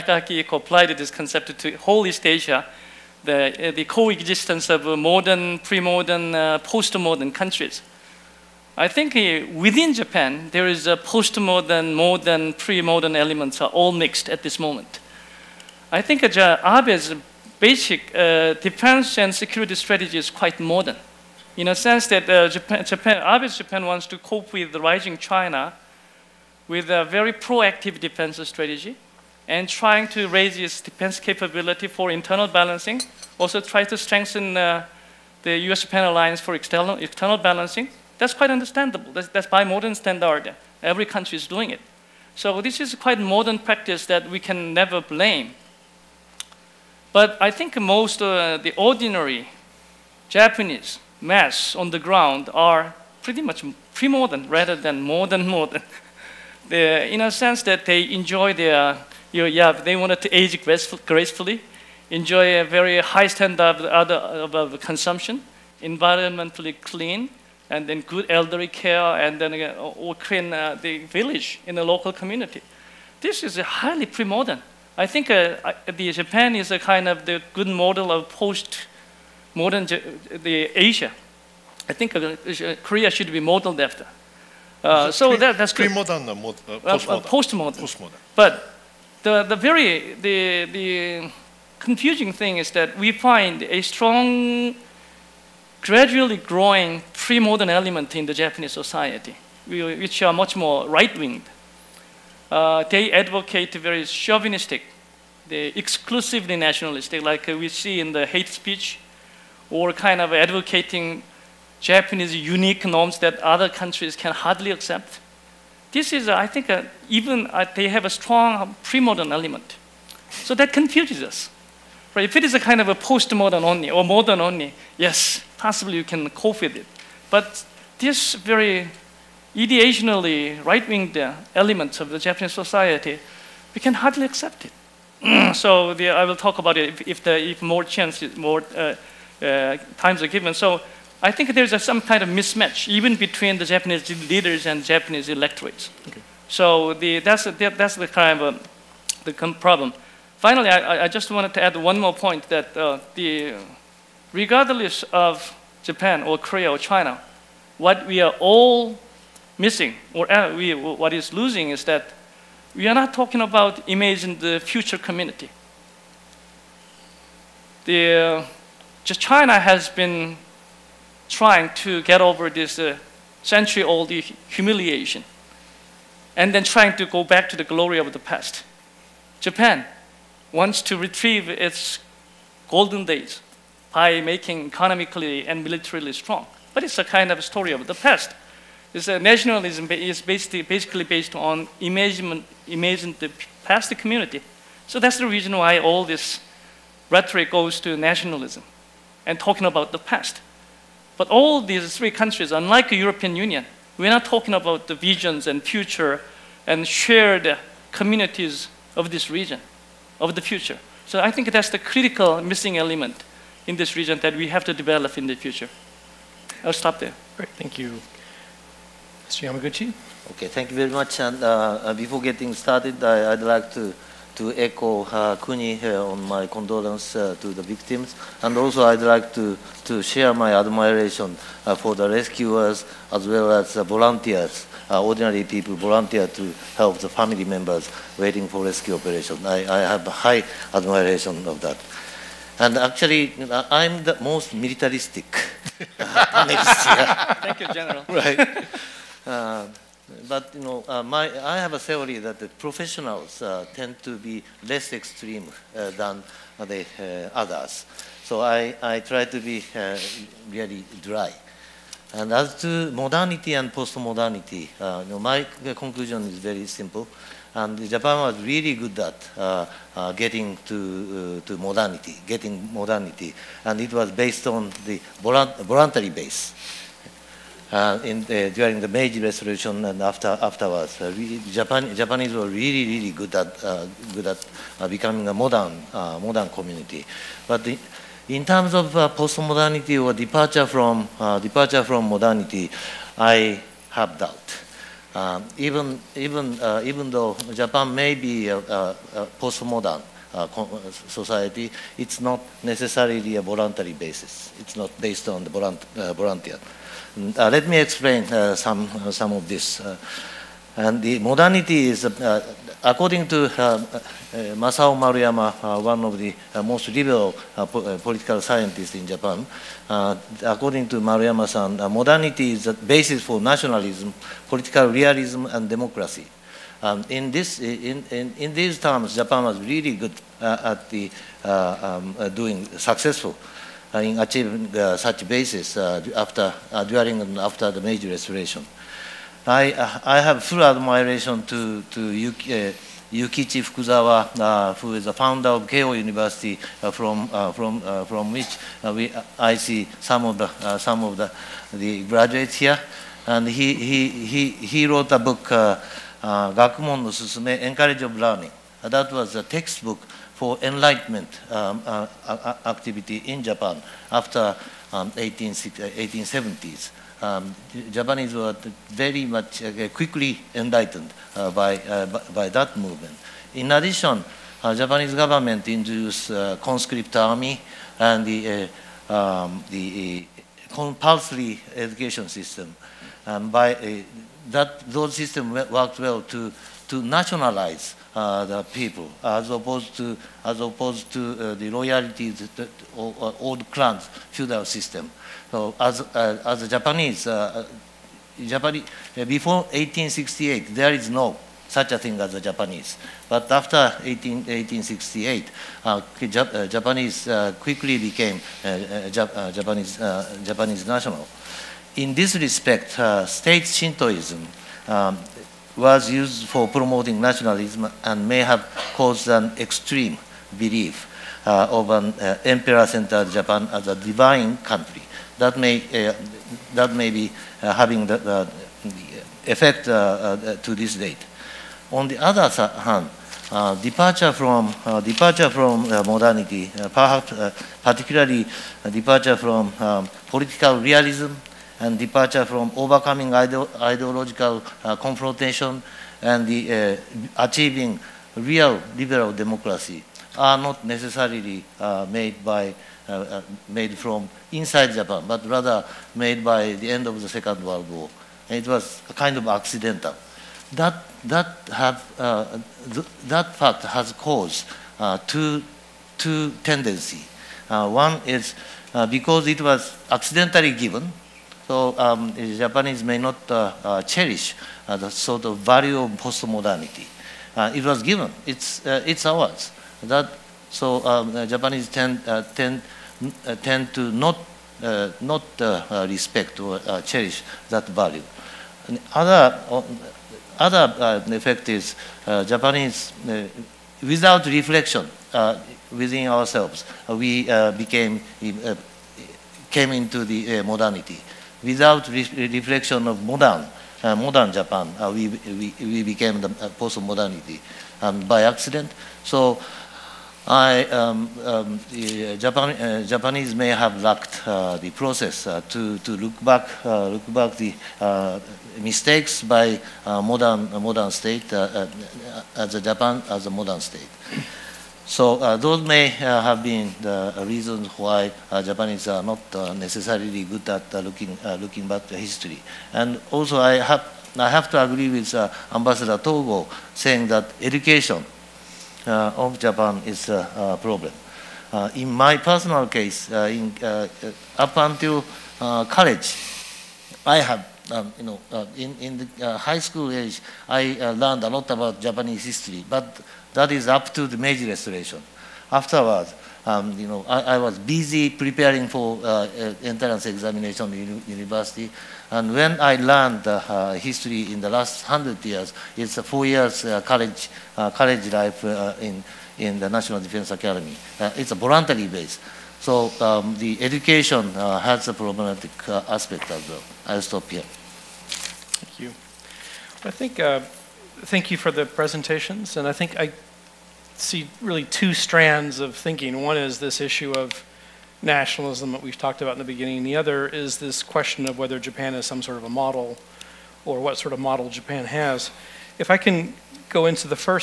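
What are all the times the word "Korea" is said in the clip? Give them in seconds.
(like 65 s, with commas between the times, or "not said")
82 s, 156 s.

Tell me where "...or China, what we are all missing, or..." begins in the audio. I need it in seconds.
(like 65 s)
156 s.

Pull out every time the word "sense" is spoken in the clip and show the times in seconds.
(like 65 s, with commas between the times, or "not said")
21 s, 57 s.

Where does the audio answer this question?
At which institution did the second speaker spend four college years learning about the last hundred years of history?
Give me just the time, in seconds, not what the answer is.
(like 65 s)
569 s.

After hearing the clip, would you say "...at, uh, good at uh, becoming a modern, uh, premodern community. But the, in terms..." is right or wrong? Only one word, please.
wrong.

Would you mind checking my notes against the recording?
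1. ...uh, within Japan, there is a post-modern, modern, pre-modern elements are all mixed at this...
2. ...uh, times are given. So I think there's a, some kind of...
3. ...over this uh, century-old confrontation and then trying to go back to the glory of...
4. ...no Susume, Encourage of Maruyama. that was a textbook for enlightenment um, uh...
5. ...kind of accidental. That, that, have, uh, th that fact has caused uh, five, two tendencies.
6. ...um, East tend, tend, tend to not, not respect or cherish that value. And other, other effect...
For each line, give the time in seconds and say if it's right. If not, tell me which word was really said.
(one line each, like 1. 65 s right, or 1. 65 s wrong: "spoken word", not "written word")
1. 9 s right
2. 139 s right
3. 172 s wrong: "humiliation", not "confrontation"
4. 357 s wrong: "Learning", not "Maruyama"
5. 459 s wrong: "two", not "five"
6. 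481 s wrong: "Japanese", not "East".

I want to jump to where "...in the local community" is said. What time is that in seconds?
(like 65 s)
71 s.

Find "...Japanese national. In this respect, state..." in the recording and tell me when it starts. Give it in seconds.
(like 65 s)
410 s.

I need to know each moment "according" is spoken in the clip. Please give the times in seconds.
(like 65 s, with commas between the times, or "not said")
312 s, 320 s.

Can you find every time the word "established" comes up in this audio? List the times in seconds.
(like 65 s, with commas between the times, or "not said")
not said.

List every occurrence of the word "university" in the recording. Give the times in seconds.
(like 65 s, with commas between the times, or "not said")
345 s, 561 s.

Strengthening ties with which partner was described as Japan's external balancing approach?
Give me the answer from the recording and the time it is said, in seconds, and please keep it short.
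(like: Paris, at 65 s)
U.S.-Japan alliance, at 35 s.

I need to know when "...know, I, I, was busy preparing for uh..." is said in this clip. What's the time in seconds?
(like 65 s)
557 s.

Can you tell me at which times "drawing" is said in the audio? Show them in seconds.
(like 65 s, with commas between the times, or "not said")
not said.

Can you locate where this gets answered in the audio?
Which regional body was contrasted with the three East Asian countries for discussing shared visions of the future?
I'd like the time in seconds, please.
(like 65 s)
202 s.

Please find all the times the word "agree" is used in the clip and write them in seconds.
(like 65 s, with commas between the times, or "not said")
534 s.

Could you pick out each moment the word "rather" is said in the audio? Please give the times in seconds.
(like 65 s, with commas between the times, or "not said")
54 s, 455 s.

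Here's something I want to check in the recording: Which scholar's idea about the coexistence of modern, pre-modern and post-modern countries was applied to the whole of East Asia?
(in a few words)
Akihiko.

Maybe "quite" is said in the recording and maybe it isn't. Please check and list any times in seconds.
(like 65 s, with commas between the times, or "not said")
20 s, 38 s, 42 s.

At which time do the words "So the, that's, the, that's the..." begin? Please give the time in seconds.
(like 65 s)
146 s.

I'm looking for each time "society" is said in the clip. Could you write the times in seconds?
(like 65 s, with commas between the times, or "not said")
98 s, 132 s, 301 s.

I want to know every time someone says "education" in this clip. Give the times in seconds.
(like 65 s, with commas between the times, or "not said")
381 s, 537 s, 573 s.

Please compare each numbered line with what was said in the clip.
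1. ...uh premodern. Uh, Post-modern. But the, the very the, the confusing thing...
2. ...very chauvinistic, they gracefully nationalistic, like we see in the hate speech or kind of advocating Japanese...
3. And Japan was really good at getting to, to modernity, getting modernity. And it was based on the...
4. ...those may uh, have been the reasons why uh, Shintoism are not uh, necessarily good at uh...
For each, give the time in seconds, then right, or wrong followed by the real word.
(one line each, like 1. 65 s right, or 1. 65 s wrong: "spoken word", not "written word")
1. 86 s wrong: "postmodern", not "premodern"
2. 103 s wrong: "exclusively", not "gracefully"
3. 267 s right
4. 525 s wrong: "Japanese", not "Shintoism".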